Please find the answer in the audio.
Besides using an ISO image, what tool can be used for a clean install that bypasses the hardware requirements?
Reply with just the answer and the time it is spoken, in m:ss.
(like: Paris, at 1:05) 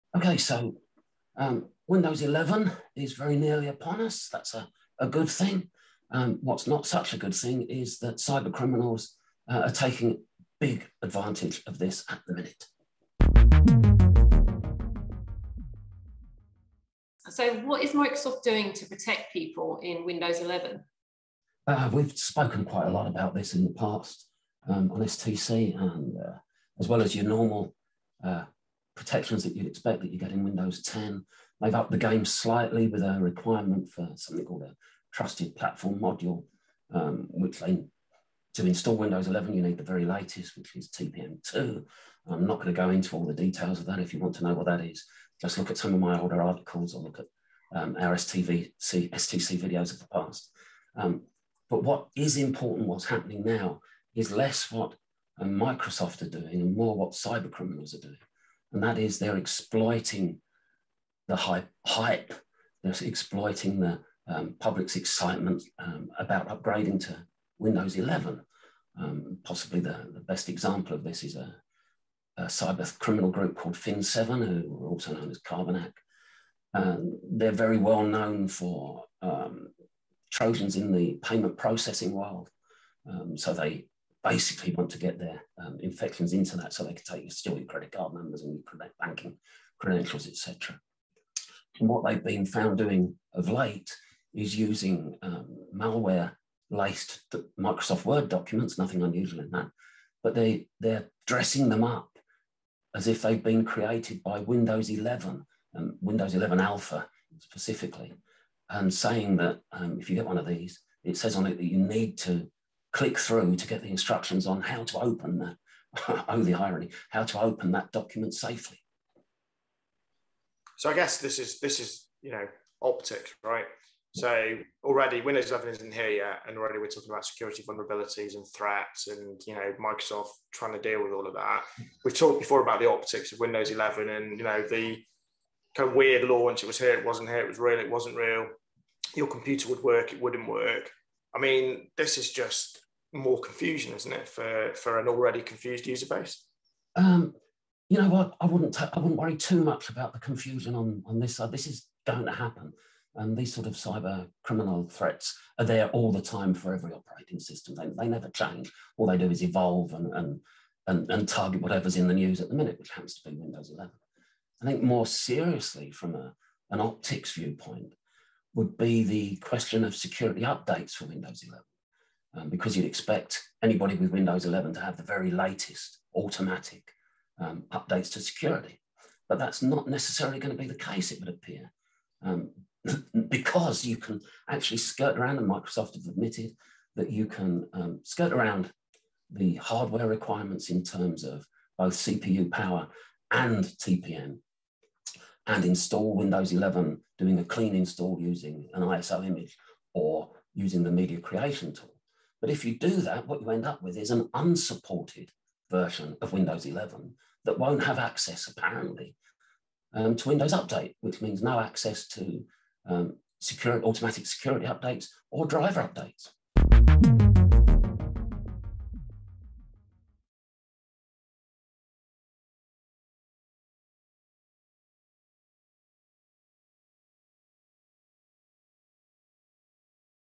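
media creation tool, at 3:20.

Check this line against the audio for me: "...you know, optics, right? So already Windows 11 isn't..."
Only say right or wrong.
right.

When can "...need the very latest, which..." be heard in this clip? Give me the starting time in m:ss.
0:39.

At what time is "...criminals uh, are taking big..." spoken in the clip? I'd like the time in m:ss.
0:08.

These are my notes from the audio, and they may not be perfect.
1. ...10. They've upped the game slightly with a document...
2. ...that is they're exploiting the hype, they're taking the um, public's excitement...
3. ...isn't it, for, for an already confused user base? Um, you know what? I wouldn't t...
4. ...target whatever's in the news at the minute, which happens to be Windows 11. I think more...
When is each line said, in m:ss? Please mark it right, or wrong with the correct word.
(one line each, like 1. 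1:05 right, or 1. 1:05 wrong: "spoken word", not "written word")
1. 0:30 wrong: "requirement", not "document"
2. 0:58 wrong: "exploiting", not "taking"
3. 2:23 right
4. 2:41 right.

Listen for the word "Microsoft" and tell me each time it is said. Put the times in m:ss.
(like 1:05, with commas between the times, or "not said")
0:17, 0:55, 1:37, 2:09, 3:05.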